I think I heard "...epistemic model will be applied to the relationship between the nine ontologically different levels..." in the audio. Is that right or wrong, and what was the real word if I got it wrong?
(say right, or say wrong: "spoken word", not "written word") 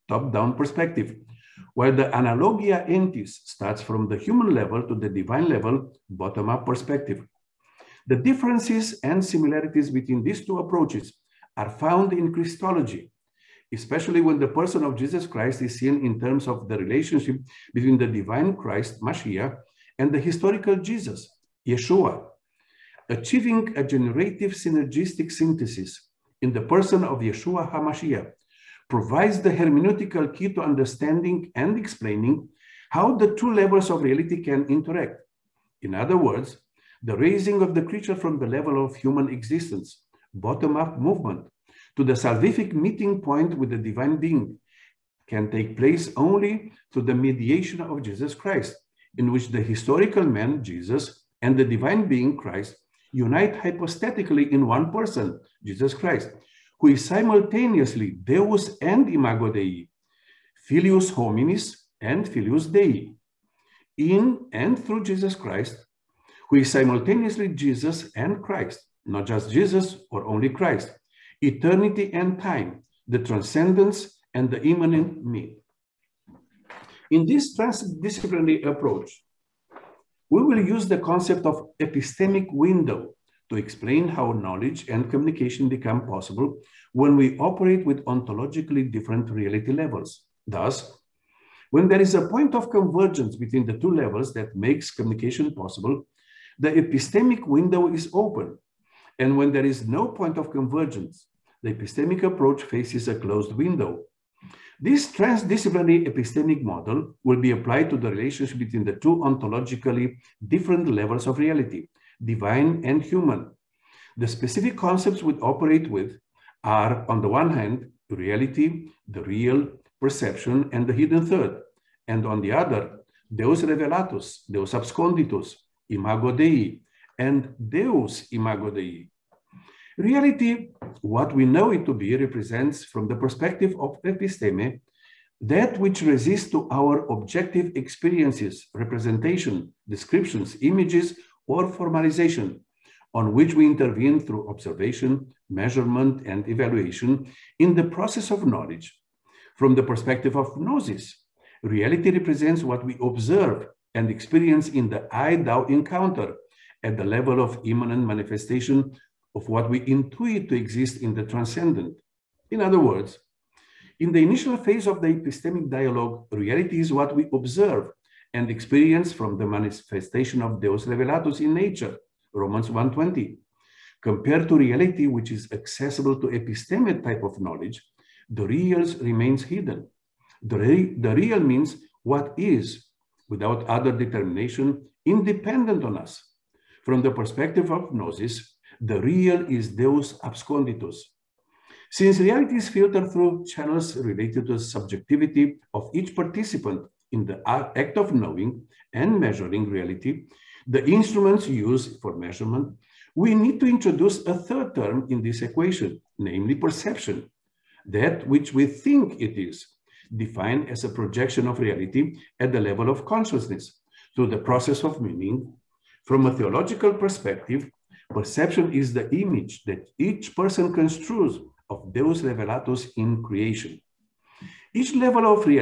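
wrong: "two", not "nine".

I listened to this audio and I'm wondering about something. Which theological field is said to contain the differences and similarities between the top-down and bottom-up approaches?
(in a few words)
Christology.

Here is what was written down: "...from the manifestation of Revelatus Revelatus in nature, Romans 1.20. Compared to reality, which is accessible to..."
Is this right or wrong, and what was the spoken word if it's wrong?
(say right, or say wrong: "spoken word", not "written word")
wrong: "Deus", not "Revelatus".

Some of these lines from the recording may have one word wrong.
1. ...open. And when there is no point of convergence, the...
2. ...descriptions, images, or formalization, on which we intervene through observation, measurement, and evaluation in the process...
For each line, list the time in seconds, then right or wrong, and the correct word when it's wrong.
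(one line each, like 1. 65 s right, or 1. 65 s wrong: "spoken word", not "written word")
1. 98 s right
2. 139 s right.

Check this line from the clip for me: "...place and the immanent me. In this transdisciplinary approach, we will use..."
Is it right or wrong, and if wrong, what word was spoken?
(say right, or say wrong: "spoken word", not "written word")
wrong: "transcendence", not "place".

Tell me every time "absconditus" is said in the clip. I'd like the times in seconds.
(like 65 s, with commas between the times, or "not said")
124 s, 190 s.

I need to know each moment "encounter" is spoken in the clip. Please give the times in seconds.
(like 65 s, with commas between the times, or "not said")
155 s.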